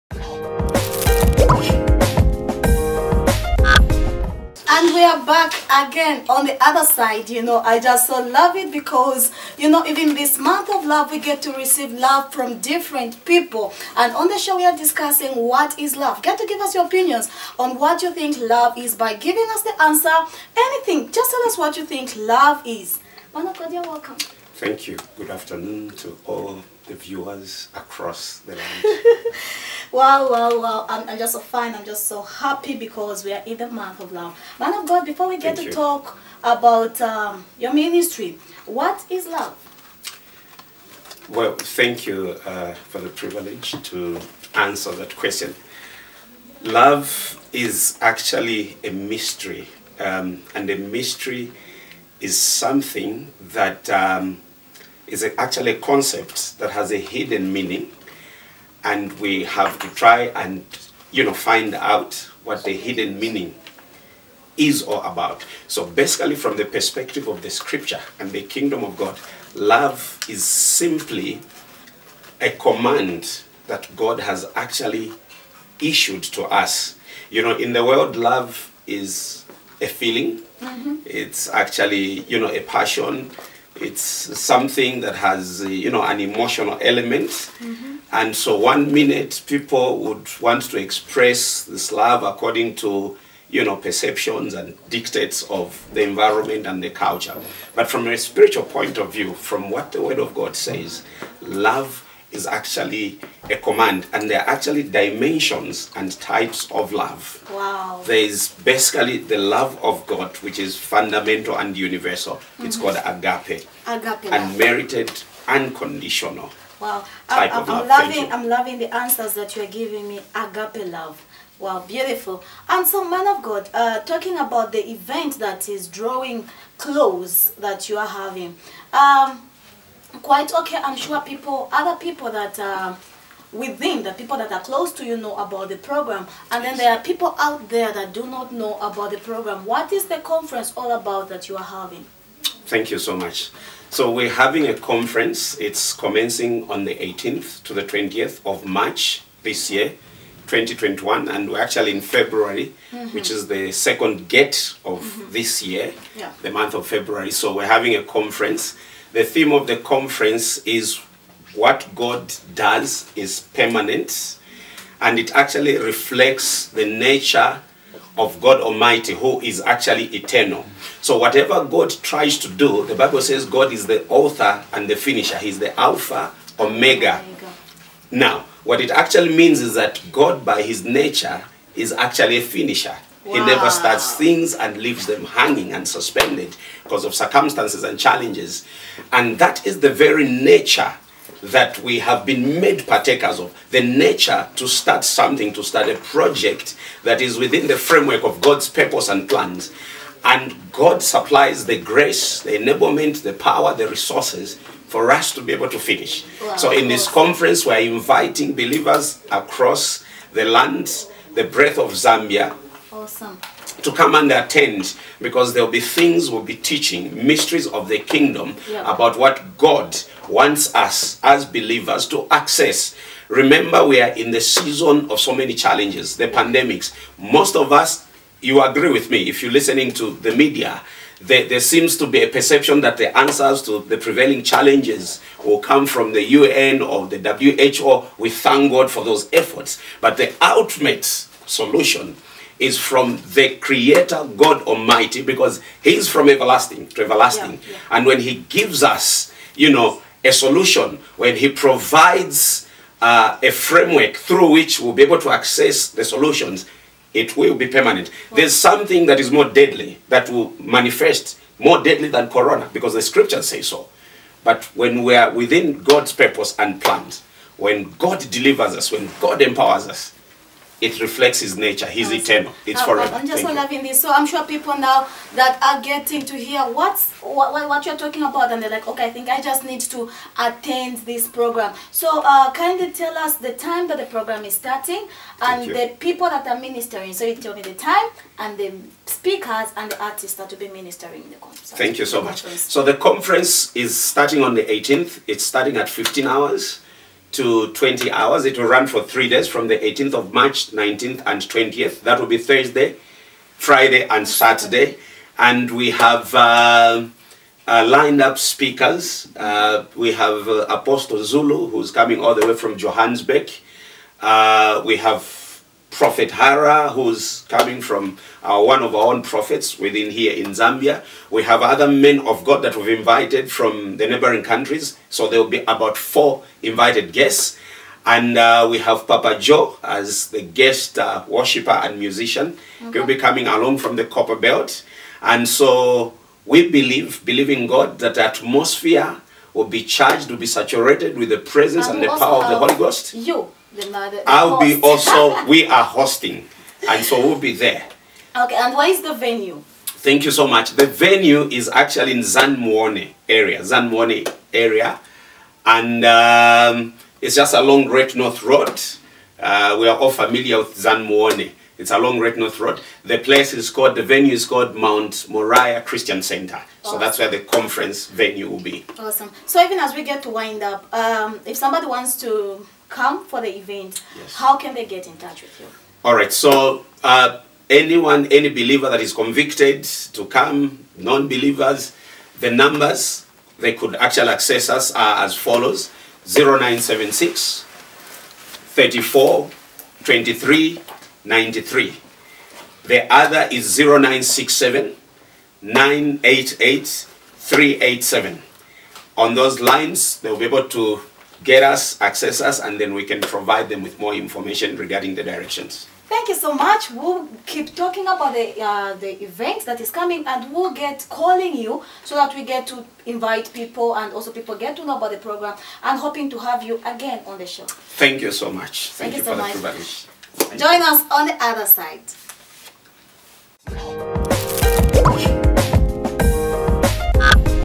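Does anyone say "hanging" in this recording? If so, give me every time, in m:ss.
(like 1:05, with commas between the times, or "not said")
3:05.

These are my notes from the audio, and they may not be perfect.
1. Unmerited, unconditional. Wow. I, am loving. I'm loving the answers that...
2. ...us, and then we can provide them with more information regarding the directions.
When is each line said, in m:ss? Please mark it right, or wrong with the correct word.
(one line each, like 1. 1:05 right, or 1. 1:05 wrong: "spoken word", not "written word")
1. 1:54 right
2. 6:42 right.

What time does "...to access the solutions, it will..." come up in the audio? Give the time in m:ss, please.
4:15.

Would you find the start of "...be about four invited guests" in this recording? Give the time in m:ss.
5:25.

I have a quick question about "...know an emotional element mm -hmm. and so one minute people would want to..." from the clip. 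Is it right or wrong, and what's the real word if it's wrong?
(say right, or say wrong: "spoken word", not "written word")
right.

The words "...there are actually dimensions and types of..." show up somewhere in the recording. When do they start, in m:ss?
1:44.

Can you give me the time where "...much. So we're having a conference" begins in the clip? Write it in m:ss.
2:23.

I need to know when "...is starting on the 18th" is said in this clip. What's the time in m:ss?
4:53.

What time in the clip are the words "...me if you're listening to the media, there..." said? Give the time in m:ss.
3:49.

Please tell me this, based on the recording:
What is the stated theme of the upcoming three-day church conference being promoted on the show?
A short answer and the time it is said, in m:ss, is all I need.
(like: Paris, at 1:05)
What God Does is Permanent, at 2:41.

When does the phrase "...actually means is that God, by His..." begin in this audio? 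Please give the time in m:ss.
2:58.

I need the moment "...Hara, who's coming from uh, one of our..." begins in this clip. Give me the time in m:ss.
5:16.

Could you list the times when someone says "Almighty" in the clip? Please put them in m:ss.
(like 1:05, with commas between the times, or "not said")
2:48, 4:04.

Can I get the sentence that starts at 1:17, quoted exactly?
You know, in the world, love is a feeling.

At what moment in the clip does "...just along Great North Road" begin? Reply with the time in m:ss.
5:57.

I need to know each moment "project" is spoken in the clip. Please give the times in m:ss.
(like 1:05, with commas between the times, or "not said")
3:15.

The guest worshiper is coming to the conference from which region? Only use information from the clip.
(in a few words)
the Copperbelt.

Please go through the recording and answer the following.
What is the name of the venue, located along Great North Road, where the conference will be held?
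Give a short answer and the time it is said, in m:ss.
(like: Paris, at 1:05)
Mount Moriah Christian Center, at 6:04.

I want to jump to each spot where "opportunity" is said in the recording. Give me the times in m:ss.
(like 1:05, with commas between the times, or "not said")
not said.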